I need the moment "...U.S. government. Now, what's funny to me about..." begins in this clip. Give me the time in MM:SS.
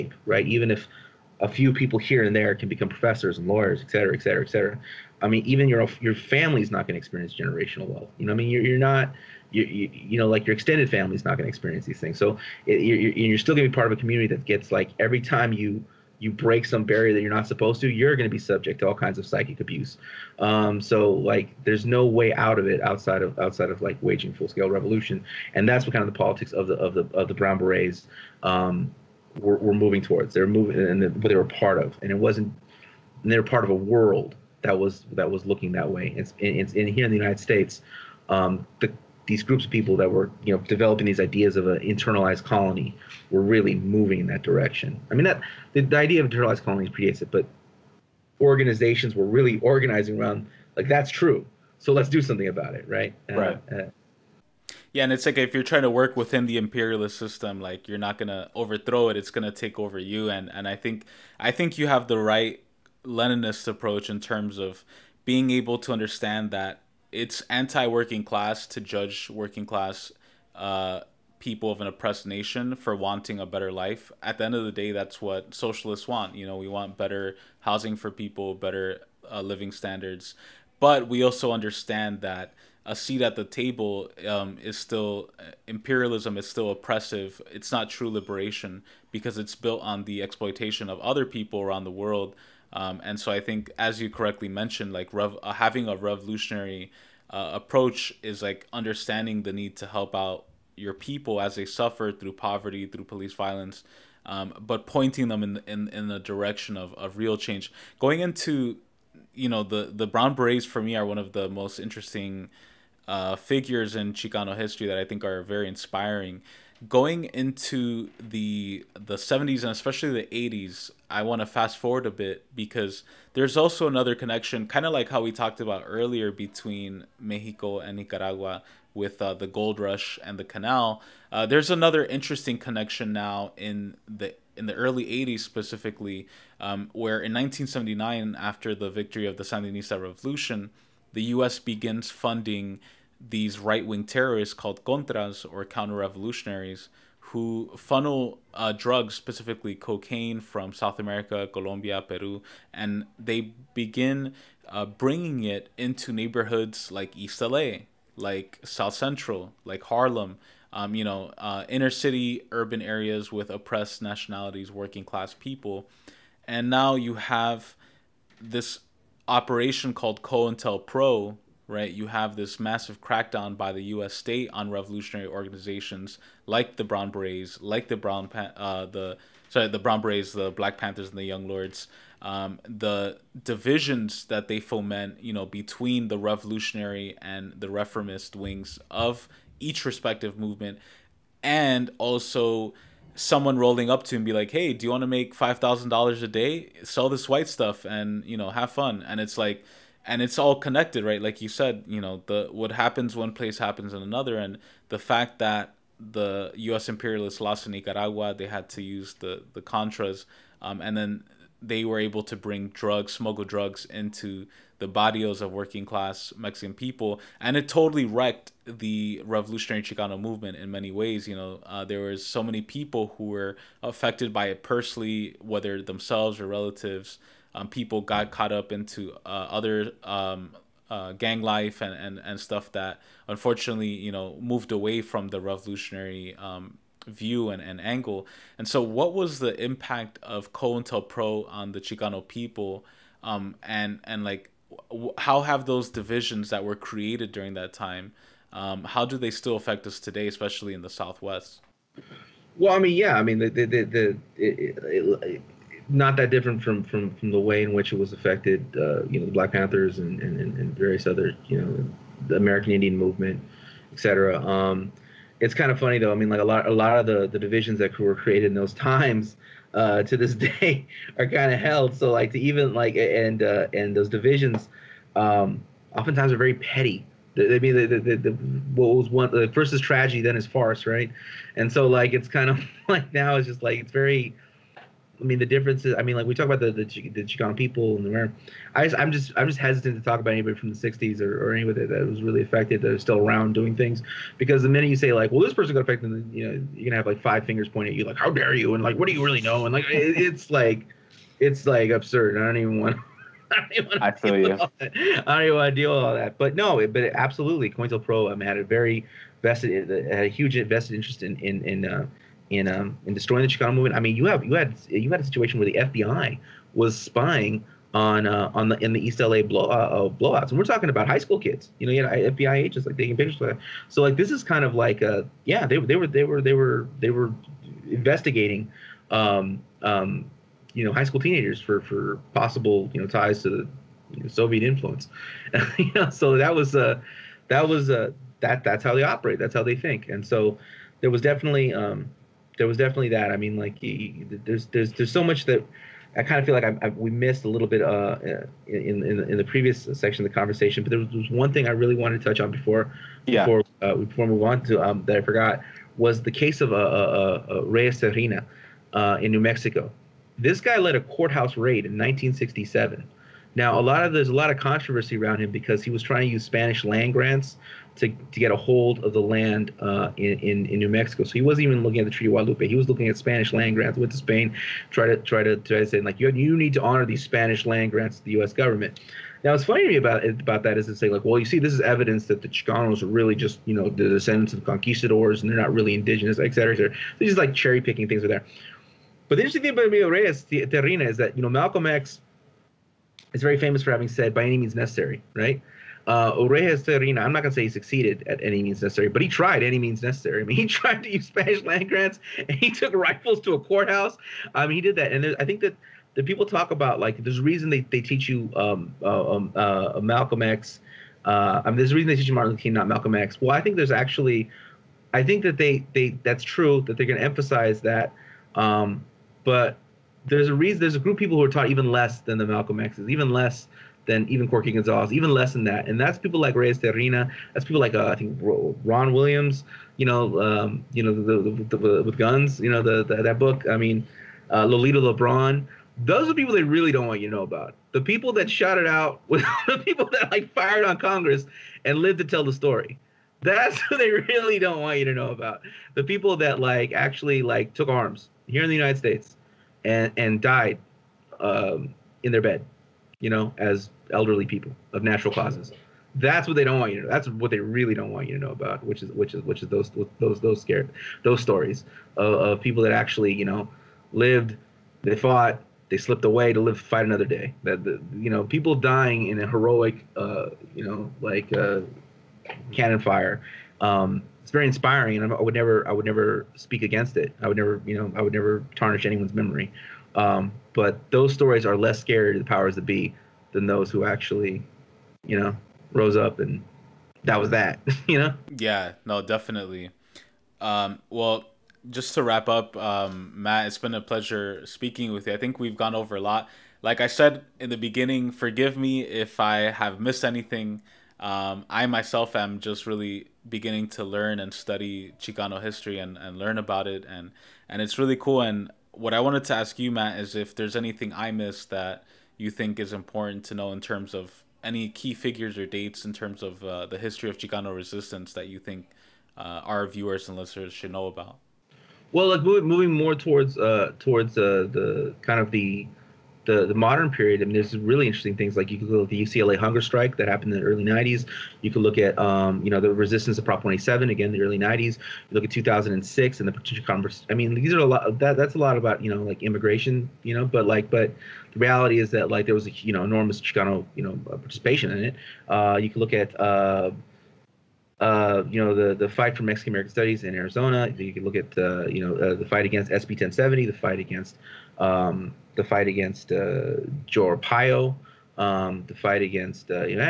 06:18.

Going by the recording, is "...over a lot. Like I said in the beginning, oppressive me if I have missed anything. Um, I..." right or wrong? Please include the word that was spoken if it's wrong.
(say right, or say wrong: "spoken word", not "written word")
wrong: "forgive", not "oppressive".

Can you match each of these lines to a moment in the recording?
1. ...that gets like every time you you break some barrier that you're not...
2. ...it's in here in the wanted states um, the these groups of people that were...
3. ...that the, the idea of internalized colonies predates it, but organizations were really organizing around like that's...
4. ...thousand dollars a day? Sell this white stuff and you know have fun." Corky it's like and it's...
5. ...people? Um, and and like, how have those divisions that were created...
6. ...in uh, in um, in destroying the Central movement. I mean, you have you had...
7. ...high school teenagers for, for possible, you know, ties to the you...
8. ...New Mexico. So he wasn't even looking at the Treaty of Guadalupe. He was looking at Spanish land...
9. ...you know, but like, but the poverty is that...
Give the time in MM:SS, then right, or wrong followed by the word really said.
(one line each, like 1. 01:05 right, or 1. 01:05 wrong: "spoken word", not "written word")
1. 00:14 right
2. 00:36 wrong: "united", not "wanted"
3. 00:45 right
4. 03:15 wrong: "And", not "Corky"
5. 04:02 right
6. 05:11 wrong: "Chicano", not "Central"
7. 05:30 right
8. 06:10 right
9. 09:00 wrong: "reality", not "poverty".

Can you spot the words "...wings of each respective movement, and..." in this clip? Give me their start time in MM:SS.
03:08.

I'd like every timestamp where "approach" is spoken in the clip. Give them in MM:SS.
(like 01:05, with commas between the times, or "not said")
01:03, 01:37.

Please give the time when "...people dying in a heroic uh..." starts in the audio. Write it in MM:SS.
07:48.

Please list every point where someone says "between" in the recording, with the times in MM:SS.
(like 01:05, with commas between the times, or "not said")
02:06, 03:05.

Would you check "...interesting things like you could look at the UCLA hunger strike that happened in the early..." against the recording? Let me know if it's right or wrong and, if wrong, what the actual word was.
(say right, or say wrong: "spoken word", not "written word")
right.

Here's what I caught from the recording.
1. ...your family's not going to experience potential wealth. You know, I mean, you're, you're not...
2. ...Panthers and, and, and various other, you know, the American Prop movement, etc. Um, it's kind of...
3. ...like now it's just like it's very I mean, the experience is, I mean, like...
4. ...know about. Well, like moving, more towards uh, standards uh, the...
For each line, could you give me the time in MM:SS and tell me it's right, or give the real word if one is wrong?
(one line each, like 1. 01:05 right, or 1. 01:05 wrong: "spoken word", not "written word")
1. 00:06 wrong: "generational", not "potential"
2. 04:19 wrong: "Indian", not "Prop"
3. 04:42 wrong: "difference", not "experience"
4. 08:40 wrong: "towards", not "standards".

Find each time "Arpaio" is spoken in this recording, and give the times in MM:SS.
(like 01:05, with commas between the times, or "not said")
09:17.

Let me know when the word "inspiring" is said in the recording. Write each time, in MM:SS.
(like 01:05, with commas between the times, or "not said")
01:55, 07:54.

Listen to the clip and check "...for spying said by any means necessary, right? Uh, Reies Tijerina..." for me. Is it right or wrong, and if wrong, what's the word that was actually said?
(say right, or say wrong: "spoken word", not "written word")
wrong: "having", not "spying".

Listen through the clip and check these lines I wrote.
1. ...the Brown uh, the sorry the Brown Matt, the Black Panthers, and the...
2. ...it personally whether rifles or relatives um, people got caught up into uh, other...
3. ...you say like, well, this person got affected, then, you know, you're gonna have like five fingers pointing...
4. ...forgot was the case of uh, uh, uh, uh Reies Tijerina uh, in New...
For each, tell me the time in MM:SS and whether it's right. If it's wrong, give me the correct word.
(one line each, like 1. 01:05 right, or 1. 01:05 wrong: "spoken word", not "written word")
1. 02:57 wrong: "Berets", not "Matt"
2. 03:44 wrong: "themselves", not "rifles"
3. 04:54 right
4. 05:55 right.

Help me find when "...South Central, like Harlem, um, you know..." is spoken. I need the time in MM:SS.
02:38.